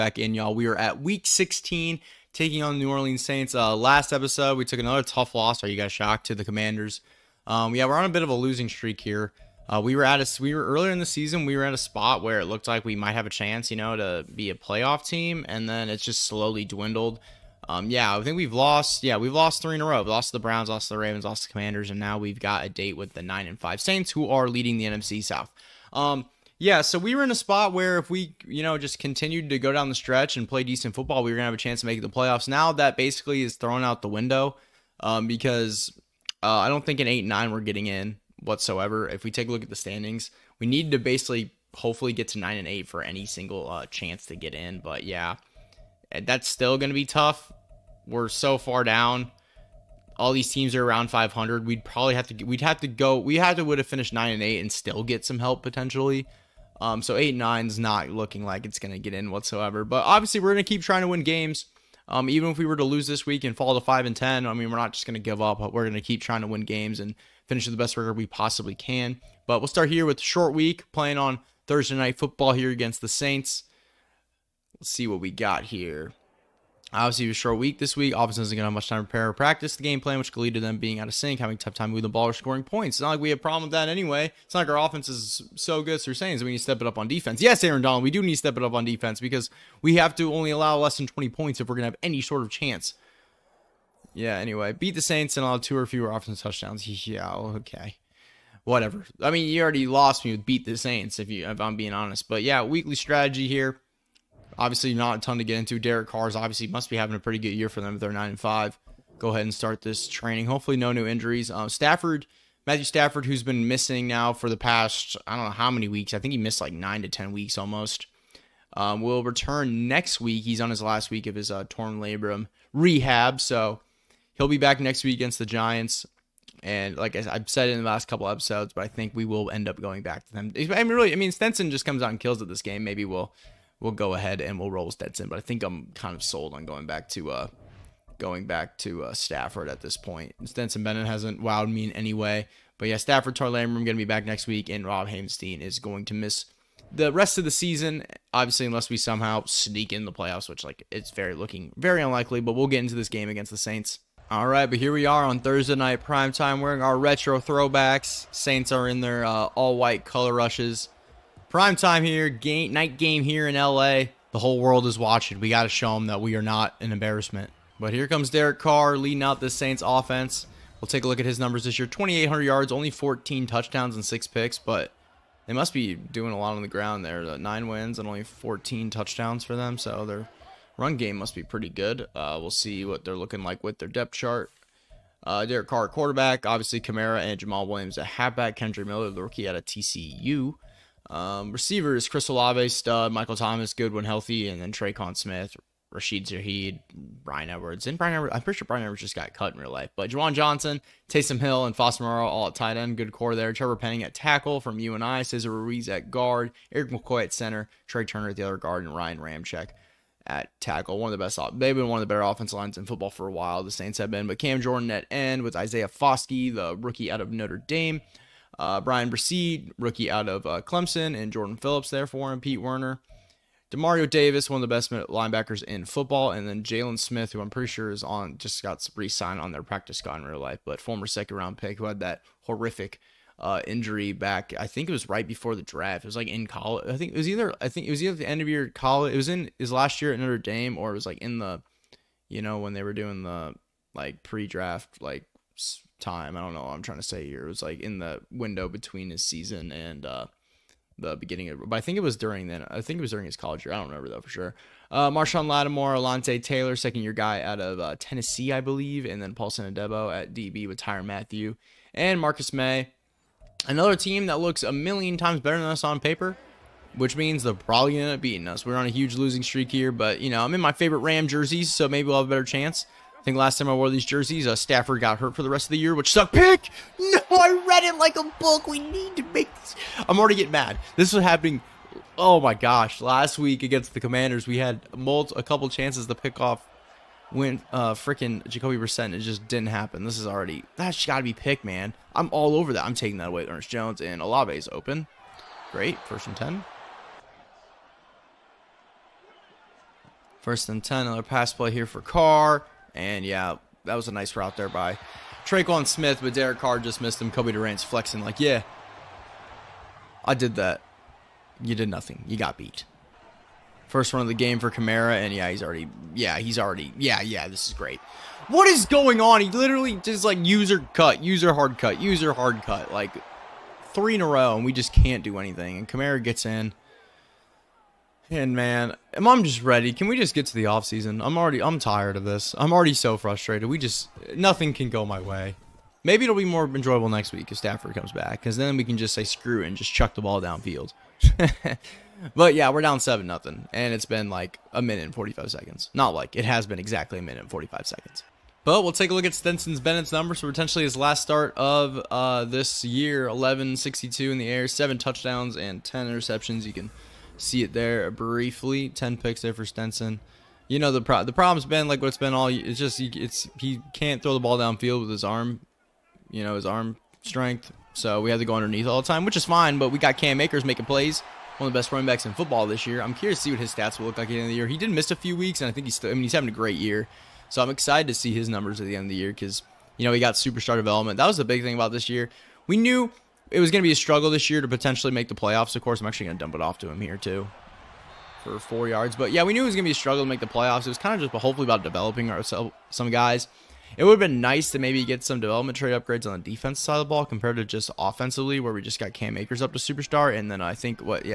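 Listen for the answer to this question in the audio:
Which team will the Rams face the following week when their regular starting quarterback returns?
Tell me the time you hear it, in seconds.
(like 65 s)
125 s.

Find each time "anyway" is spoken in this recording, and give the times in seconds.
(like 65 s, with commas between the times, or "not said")
83 s, 94 s.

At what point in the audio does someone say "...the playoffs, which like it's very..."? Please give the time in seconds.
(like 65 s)
150 s.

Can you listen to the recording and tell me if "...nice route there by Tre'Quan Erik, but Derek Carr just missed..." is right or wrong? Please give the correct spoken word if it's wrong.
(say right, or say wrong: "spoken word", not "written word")
wrong: "Smith", not "Erik".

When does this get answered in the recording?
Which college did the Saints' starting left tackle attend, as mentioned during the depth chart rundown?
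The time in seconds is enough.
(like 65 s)
204 s.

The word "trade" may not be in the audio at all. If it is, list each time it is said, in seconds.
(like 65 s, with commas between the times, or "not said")
395 s.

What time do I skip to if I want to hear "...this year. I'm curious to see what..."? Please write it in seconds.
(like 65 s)
372 s.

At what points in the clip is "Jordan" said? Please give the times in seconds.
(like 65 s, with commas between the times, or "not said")
214 s, 221 s.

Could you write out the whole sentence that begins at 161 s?
Prime time here, game night game here in LA.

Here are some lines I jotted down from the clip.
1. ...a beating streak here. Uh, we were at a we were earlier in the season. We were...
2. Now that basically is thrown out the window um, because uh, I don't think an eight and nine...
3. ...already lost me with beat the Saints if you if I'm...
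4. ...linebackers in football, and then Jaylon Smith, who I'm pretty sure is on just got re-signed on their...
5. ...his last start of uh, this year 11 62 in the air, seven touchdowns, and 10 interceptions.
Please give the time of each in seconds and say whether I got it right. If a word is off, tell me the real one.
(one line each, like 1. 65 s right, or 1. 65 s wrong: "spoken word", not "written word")
1. 8 s wrong: "losing", not "beating"
2. 32 s right
3. 99 s right
4. 224 s right
5. 350 s right.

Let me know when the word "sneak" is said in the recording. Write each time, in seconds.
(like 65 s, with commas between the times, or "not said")
149 s.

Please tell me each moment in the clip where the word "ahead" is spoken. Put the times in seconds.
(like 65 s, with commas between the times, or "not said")
109 s, 134 s.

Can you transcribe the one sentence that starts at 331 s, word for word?
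I'm already, I'm tired of this.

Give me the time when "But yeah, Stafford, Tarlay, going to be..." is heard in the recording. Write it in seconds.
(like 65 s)
142 s.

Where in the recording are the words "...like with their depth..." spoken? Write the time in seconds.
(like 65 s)
183 s.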